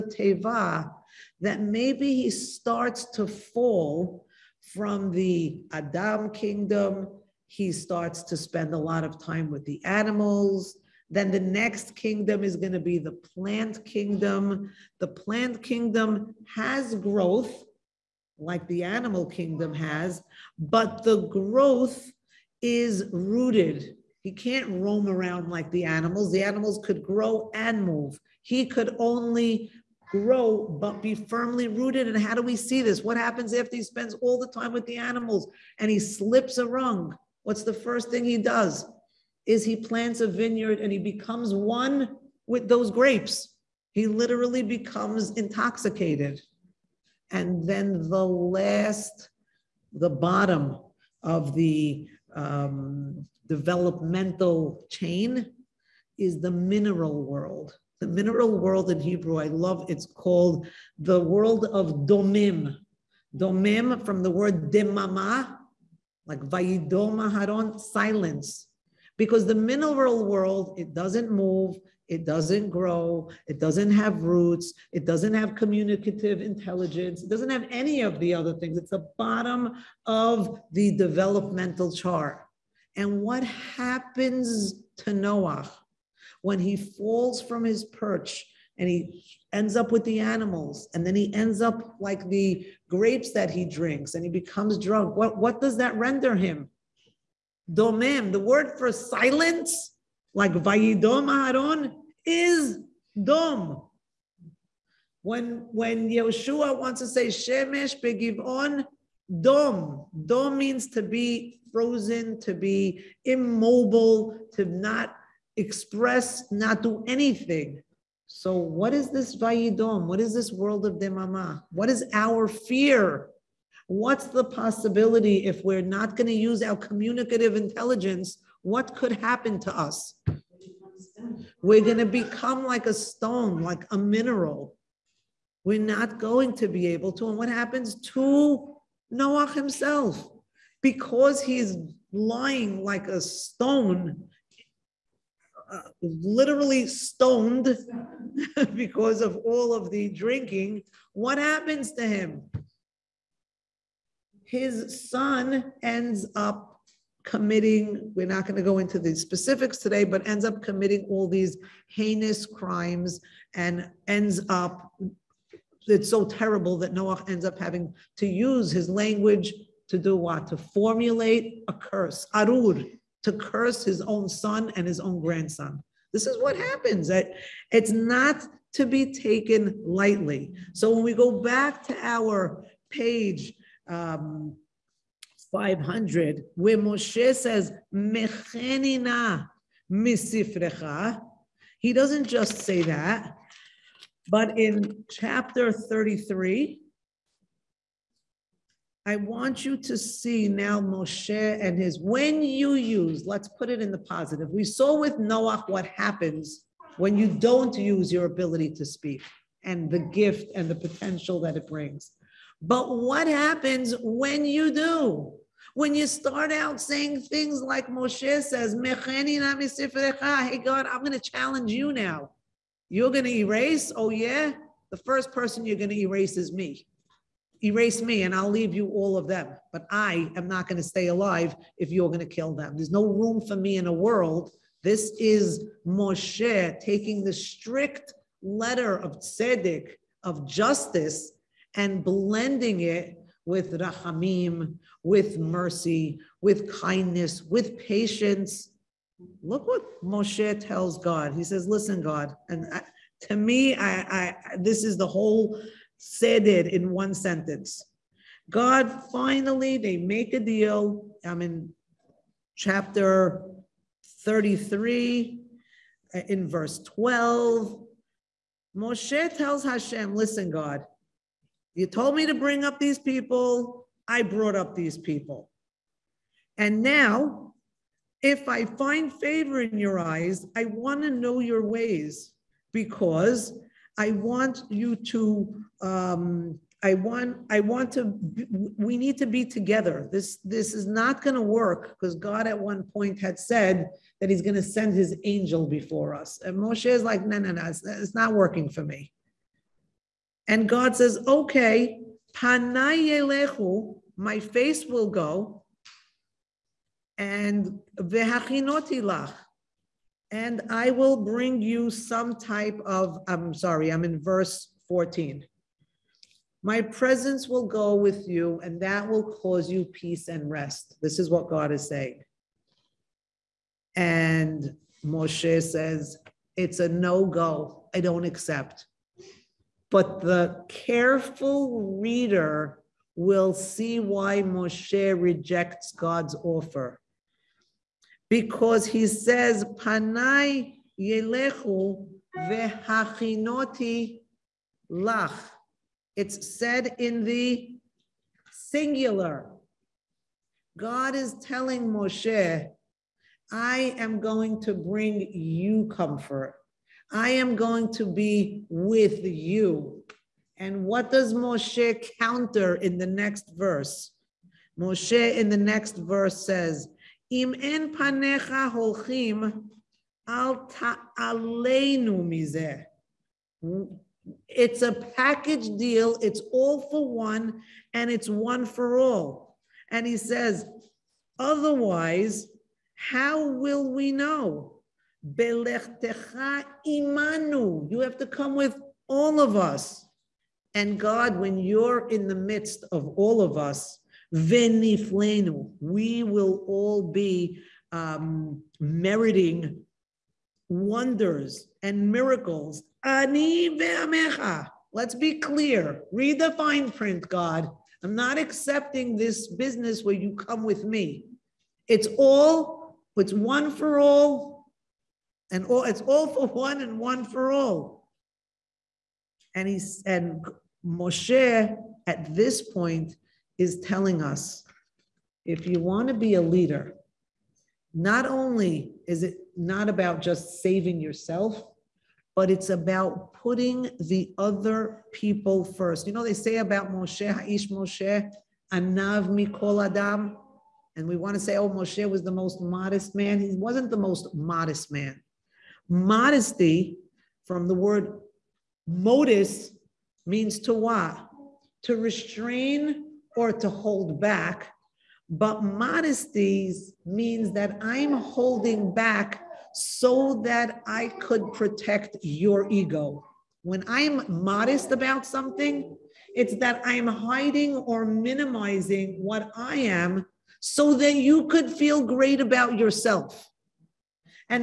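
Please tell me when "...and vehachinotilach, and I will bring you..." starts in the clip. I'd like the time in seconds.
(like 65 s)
307 s.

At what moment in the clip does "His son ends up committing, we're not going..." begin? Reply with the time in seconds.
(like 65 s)
154 s.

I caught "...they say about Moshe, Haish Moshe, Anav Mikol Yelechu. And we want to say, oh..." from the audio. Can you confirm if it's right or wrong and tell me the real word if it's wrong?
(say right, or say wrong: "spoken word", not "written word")
wrong: "Adam", not "Yelechu".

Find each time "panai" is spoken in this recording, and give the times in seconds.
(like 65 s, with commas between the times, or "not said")
302 s, 339 s.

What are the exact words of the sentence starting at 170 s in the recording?
To formulate a curse, arur, to curse his own son and his own grandson.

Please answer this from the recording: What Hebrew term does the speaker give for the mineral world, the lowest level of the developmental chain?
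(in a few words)
domim.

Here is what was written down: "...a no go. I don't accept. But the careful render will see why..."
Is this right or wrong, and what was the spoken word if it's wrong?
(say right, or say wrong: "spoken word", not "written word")
wrong: "reader", not "render".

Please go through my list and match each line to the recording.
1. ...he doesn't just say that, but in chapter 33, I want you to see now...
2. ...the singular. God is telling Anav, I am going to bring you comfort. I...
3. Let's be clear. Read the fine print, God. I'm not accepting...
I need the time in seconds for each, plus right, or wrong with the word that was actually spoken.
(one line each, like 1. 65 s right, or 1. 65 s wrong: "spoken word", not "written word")
1. 191 s right
2. 347 s wrong: "Moshe", not "Anav"
3. 404 s right.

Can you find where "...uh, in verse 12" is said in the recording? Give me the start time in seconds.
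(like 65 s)
266 s.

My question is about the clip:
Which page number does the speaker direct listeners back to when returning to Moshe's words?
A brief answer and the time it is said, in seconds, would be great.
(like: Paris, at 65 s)
500, at 185 s.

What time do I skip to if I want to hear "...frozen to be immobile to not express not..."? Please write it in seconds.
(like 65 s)
111 s.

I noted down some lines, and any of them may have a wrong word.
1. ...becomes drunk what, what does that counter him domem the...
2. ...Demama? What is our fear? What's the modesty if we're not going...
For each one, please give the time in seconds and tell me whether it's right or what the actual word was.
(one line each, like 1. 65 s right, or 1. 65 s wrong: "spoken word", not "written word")
1. 94 s wrong: "render", not "counter"
2. 120 s wrong: "possibility", not "modesty".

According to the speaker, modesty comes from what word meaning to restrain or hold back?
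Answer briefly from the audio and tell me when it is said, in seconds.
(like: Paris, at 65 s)
modus, at 448 s.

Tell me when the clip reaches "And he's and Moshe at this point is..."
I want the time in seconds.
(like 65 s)
419 s.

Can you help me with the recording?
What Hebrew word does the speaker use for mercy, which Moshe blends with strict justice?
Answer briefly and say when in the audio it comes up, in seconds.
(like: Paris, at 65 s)
rahamim, at 243 s.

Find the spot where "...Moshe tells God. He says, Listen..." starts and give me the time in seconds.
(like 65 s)
250 s.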